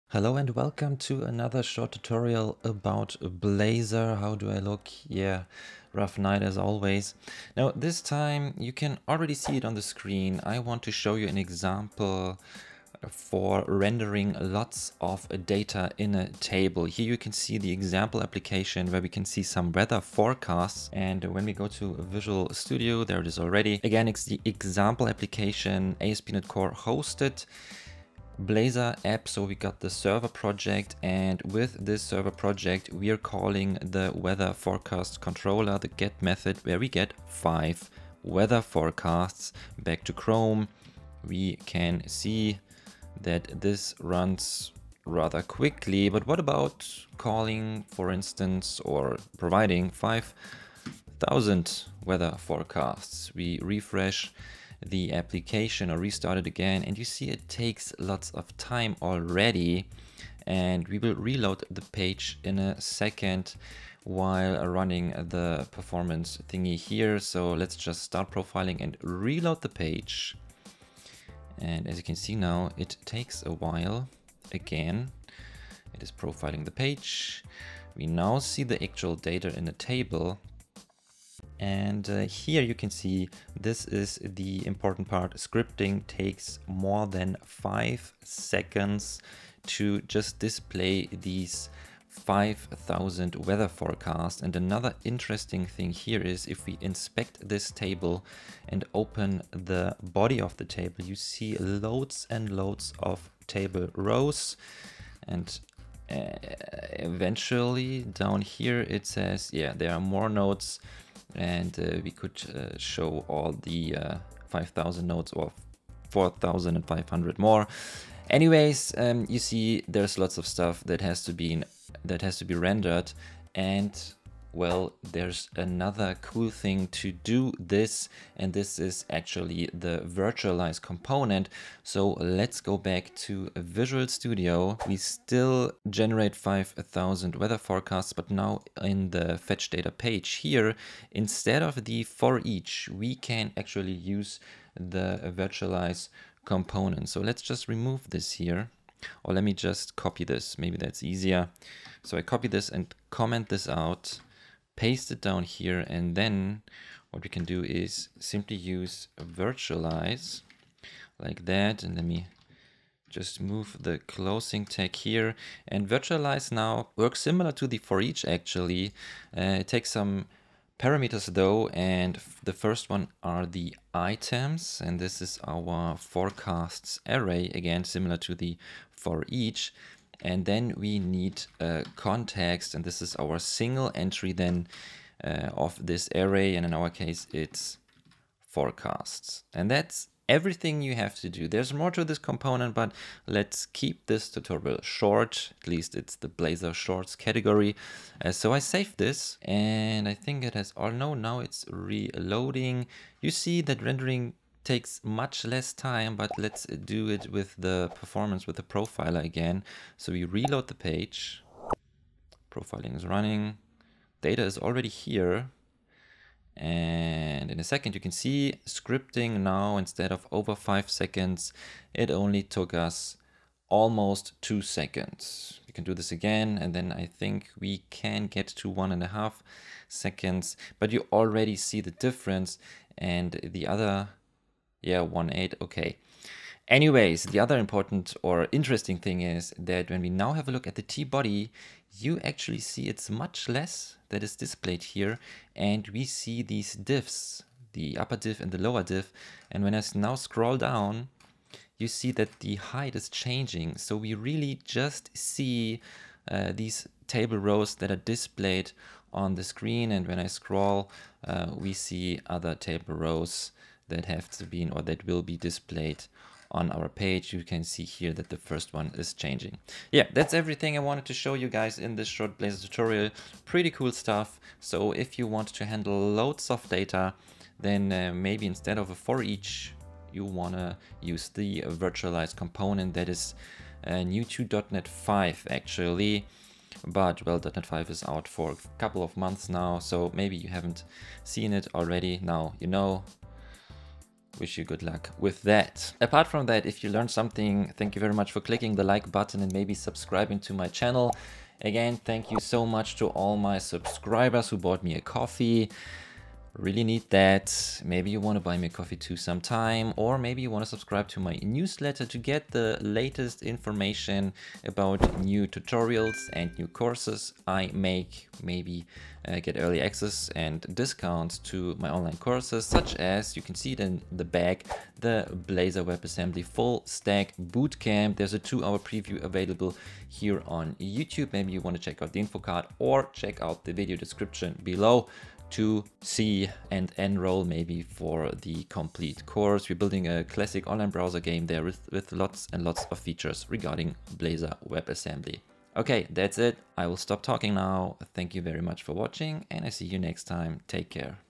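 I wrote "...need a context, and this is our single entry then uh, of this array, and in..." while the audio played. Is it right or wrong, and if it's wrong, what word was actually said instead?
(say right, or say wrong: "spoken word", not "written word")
right.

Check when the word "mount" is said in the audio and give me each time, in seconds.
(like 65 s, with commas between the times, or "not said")
not said.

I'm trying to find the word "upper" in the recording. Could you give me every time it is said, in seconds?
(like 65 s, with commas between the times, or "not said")
247 s.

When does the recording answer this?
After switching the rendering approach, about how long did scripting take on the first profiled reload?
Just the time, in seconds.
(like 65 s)
223 s.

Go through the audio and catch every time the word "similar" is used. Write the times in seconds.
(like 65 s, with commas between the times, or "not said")
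167 s, 177 s.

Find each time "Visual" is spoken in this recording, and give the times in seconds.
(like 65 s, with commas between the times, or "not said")
22 s, 133 s.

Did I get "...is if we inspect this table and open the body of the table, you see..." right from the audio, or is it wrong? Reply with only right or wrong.
right.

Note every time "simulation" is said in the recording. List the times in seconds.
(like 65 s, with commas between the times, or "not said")
not said.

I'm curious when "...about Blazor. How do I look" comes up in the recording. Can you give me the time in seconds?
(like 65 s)
2 s.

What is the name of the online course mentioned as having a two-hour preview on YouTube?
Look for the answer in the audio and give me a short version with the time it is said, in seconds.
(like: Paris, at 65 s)
Blazor WebAssembly Full Stack Bootcamp, at 325 s.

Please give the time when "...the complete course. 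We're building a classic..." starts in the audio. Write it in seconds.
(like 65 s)
338 s.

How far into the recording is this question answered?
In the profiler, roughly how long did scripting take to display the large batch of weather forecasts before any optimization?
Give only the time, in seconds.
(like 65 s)
86 s.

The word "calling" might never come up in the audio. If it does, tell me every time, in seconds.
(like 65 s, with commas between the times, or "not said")
33 s, 47 s.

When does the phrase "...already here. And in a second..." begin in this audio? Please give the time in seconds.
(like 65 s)
214 s.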